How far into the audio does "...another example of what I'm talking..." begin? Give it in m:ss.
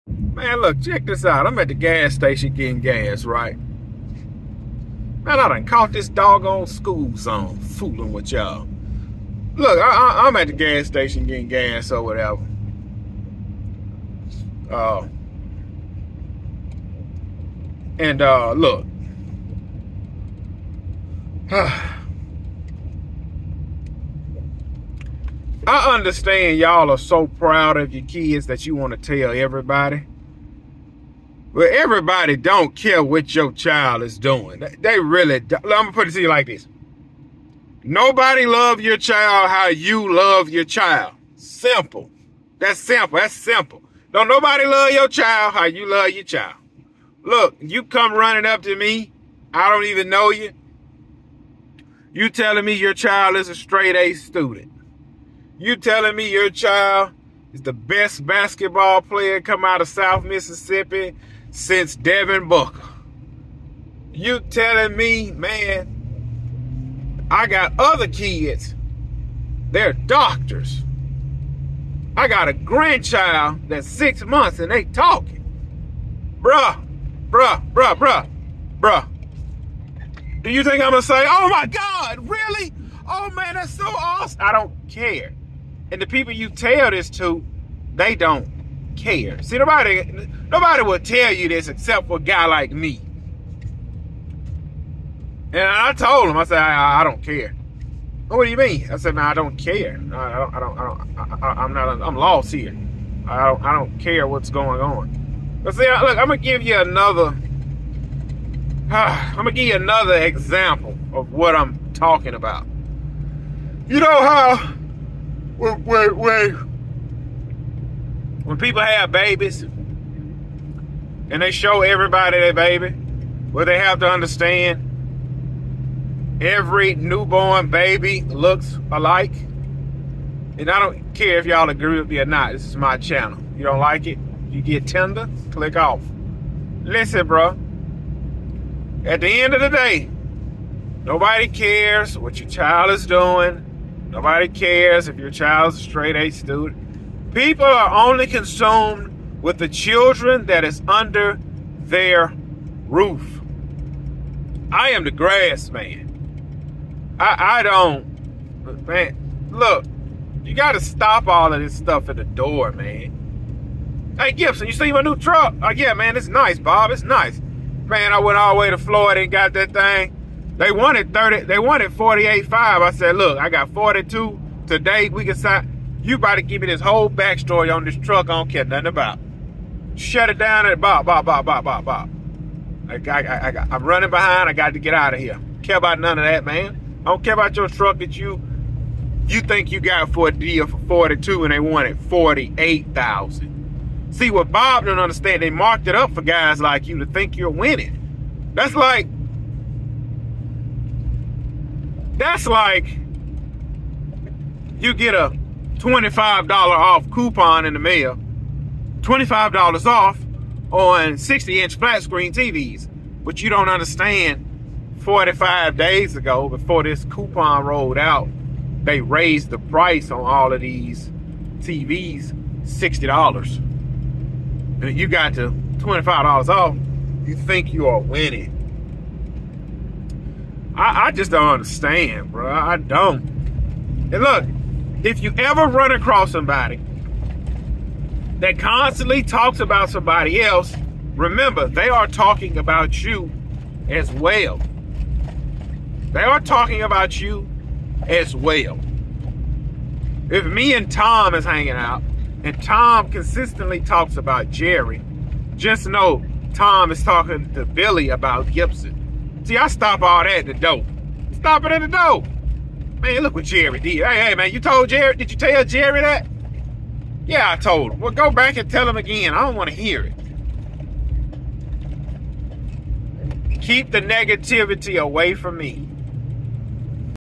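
1:49.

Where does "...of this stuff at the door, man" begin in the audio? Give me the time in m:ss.
2:41.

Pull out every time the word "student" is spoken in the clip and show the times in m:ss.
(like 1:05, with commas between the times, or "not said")
0:54, 2:26.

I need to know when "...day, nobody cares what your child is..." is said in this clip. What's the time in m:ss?
2:19.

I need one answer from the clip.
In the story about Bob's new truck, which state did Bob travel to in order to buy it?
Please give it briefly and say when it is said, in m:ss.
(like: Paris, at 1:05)
Florida, at 2:48.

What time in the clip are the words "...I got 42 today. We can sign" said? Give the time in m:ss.
2:53.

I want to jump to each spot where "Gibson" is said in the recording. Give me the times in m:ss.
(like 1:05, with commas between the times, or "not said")
2:44, 4:18.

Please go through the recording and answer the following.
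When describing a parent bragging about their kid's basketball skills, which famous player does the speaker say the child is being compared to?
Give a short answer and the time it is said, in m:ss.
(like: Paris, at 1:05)
Devin Booker, at 1:01.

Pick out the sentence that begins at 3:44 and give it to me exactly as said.
And you got to $25 off, you think you are winning.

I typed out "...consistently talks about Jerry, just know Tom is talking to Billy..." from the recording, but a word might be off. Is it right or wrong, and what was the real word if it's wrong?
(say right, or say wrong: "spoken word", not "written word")
right.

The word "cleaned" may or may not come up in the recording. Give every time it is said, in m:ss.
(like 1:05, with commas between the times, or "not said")
not said.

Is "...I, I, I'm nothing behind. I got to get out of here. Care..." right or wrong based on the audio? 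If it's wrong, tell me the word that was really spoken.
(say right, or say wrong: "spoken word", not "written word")
wrong: "running", not "nothing".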